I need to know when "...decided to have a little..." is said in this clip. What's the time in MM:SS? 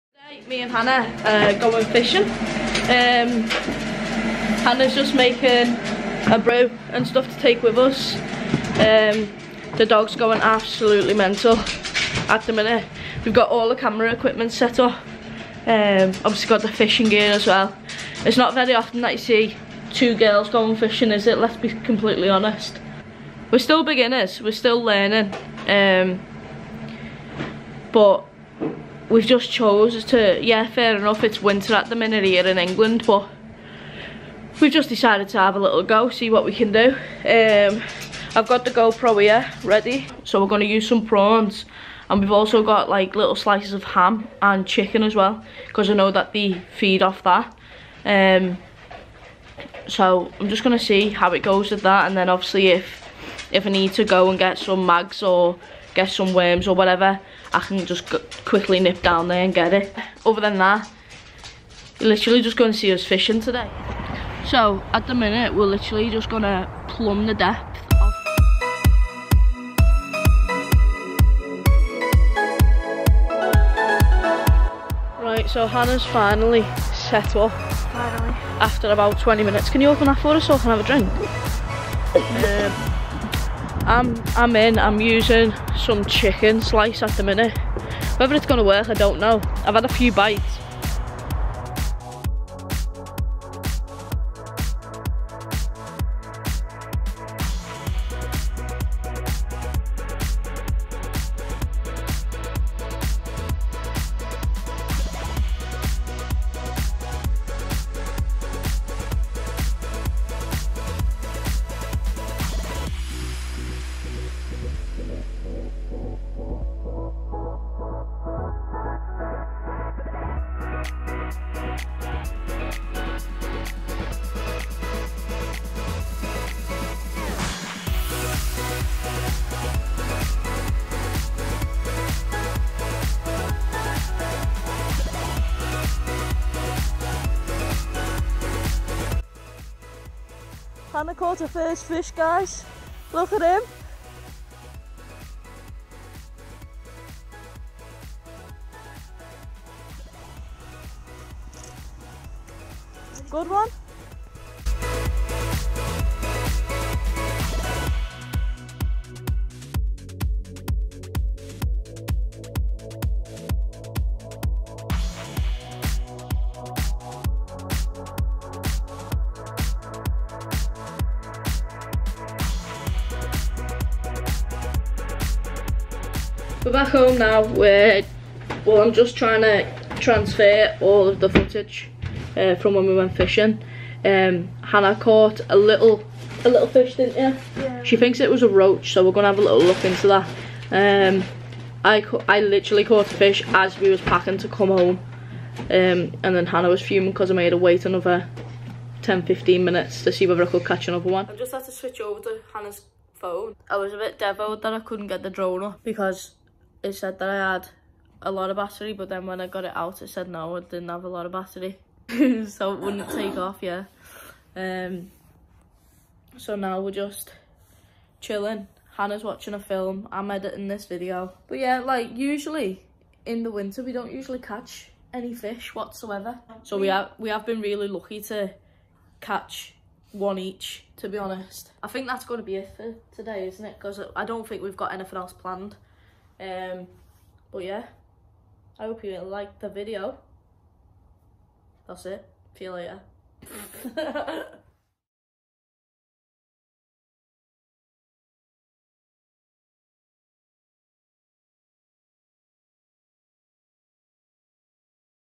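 00:34.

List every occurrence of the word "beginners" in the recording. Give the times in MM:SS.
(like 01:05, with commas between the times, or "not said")
00:23.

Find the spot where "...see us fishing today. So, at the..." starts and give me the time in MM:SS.
01:02.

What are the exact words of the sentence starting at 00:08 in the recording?
Um, the dog's going absolutely mental at the minute.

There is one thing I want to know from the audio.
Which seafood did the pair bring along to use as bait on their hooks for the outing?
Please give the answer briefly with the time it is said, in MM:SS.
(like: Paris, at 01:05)
prawns, at 00:41.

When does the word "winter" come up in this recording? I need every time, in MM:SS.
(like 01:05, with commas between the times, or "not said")
00:31, 03:43.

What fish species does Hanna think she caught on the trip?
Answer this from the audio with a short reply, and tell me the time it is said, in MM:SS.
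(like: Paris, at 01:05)
roach, at 03:08.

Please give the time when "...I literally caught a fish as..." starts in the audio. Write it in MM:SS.
03:12.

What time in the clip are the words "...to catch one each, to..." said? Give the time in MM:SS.
03:48.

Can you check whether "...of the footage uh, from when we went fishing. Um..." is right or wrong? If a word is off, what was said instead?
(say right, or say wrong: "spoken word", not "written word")
right.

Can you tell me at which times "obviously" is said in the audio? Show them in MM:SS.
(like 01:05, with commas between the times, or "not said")
00:16, 00:52.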